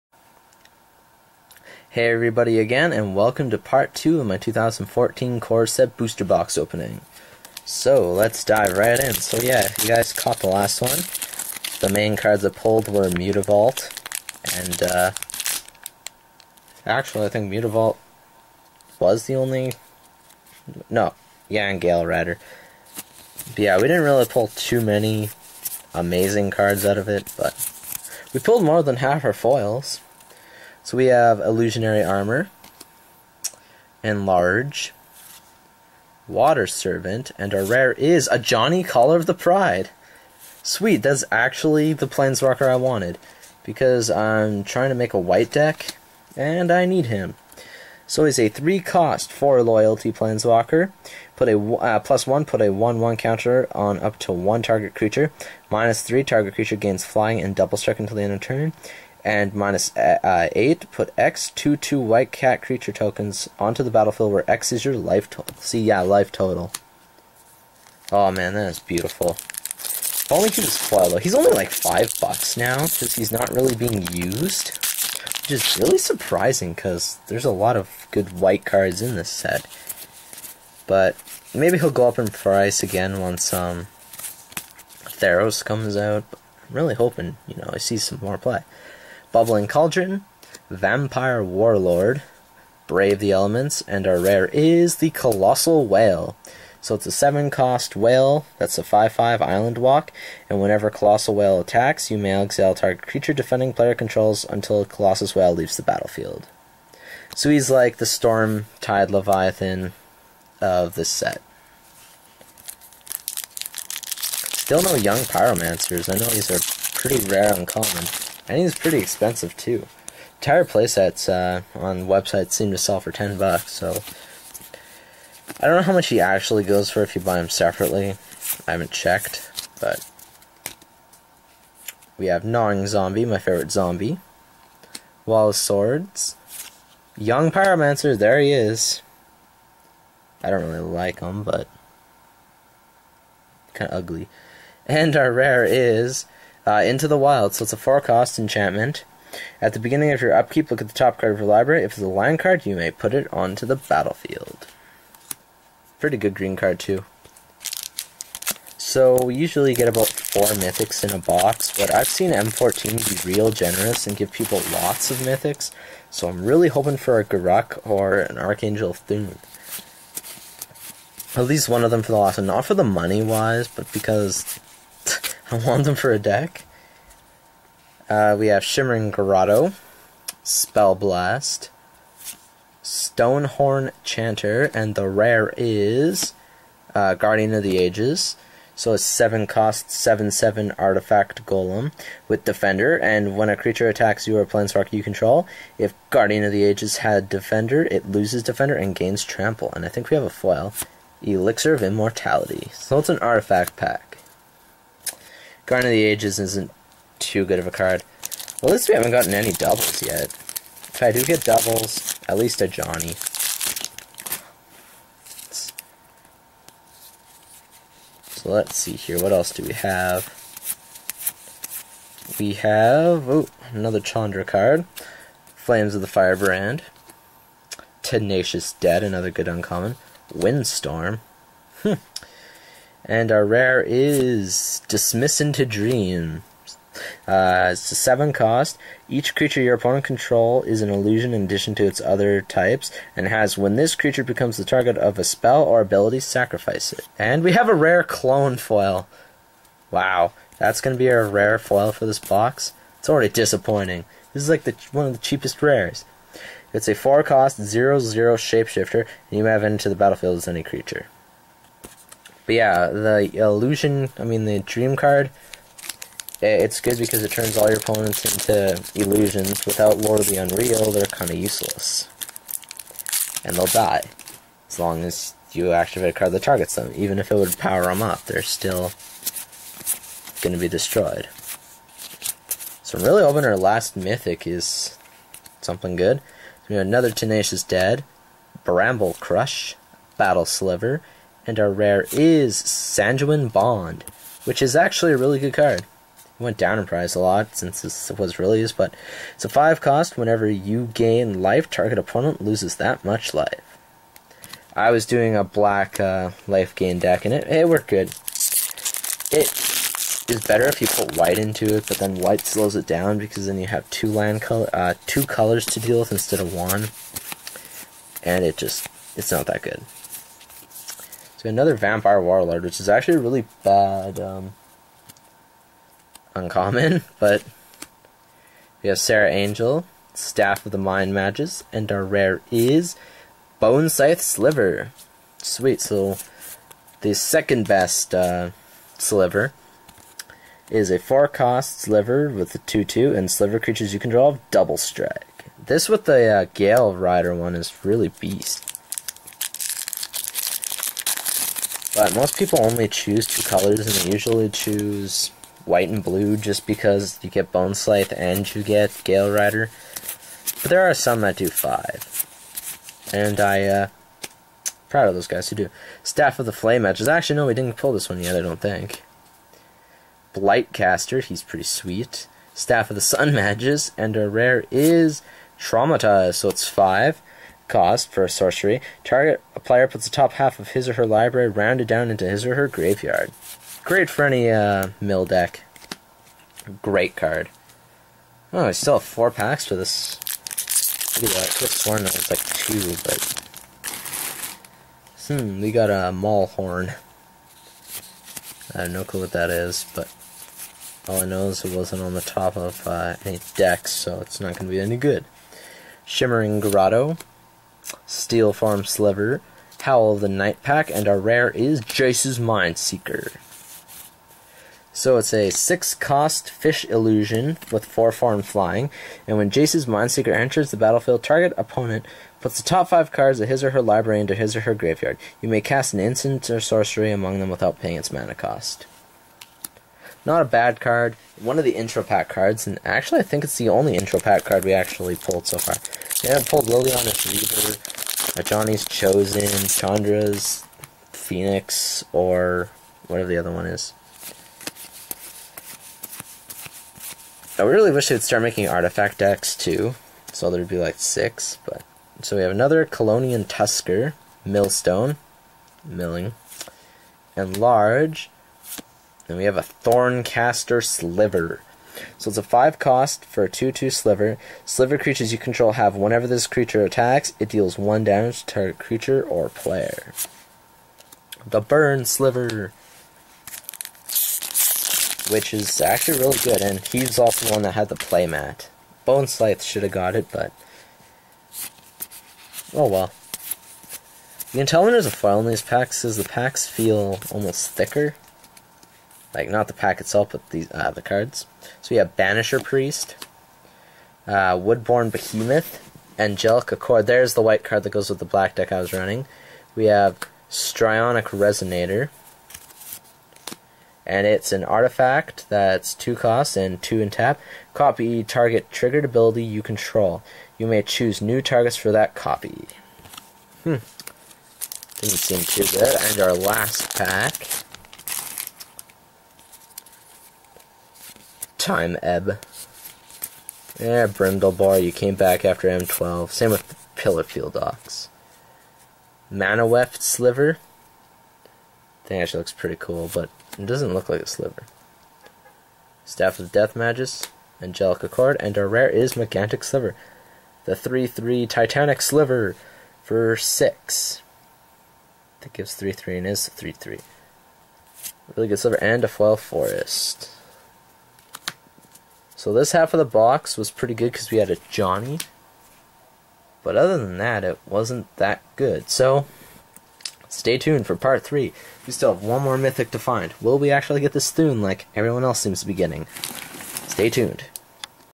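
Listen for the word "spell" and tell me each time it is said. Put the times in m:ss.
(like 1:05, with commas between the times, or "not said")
3:00, 4:05.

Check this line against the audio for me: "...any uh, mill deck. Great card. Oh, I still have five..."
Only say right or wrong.
wrong.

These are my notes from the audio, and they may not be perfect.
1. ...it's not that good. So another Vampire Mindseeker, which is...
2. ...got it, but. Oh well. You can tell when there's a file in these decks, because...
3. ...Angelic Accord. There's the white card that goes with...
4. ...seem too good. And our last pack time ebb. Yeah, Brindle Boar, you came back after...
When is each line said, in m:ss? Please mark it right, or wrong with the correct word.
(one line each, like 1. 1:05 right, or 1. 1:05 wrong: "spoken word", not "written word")
1. 5:19 wrong: "Warlord", not "Mindseeker"
2. 7:59 wrong: "packs", not "decks"
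3. 8:16 right
4. 8:35 right.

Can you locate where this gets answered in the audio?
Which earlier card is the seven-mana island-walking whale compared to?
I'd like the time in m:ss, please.
1:48.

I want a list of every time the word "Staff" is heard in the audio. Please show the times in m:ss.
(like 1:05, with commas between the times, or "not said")
5:30, 6:06, 6:12, 8:56.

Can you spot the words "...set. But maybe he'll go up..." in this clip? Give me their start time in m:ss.
1:19.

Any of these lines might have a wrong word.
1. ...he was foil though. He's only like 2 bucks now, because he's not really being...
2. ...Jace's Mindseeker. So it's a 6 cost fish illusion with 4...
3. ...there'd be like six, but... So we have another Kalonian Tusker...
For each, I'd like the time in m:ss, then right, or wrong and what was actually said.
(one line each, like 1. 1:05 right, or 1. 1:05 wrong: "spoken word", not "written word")
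1. 1:10 wrong: "5", not "2"
2. 6:51 right
3. 7:30 right.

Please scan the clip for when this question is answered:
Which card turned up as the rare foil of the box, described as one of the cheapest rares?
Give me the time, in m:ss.
4:08.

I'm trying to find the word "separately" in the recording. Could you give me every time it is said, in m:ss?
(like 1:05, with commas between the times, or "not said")
2:07.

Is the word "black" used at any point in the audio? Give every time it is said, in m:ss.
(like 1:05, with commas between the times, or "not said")
5:05, 8:18.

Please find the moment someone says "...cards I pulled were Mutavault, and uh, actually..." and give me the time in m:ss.
0:12.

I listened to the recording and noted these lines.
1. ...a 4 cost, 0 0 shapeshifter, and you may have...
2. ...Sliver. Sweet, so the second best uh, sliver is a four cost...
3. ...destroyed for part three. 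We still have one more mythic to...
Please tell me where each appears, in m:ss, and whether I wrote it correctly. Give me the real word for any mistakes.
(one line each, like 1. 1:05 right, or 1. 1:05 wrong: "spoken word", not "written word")
1. 4:16 right
2. 5:34 right
3. 9:20 wrong: "tuned", not "destroyed".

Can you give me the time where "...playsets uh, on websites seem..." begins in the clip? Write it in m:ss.
2:00.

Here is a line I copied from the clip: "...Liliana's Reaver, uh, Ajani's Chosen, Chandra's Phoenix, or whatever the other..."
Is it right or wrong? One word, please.
right.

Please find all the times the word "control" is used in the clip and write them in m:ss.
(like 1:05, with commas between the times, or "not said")
1:43, 3:15, 4:00, 7:45, 8:29.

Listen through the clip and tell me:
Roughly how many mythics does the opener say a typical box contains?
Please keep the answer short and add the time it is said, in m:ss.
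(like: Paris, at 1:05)
4, at 2:40.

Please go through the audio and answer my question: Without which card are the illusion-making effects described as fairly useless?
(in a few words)
Lord of the Unreal.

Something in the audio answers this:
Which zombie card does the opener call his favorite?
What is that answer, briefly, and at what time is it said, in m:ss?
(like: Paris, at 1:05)
Gnawing Zombie, at 2:12.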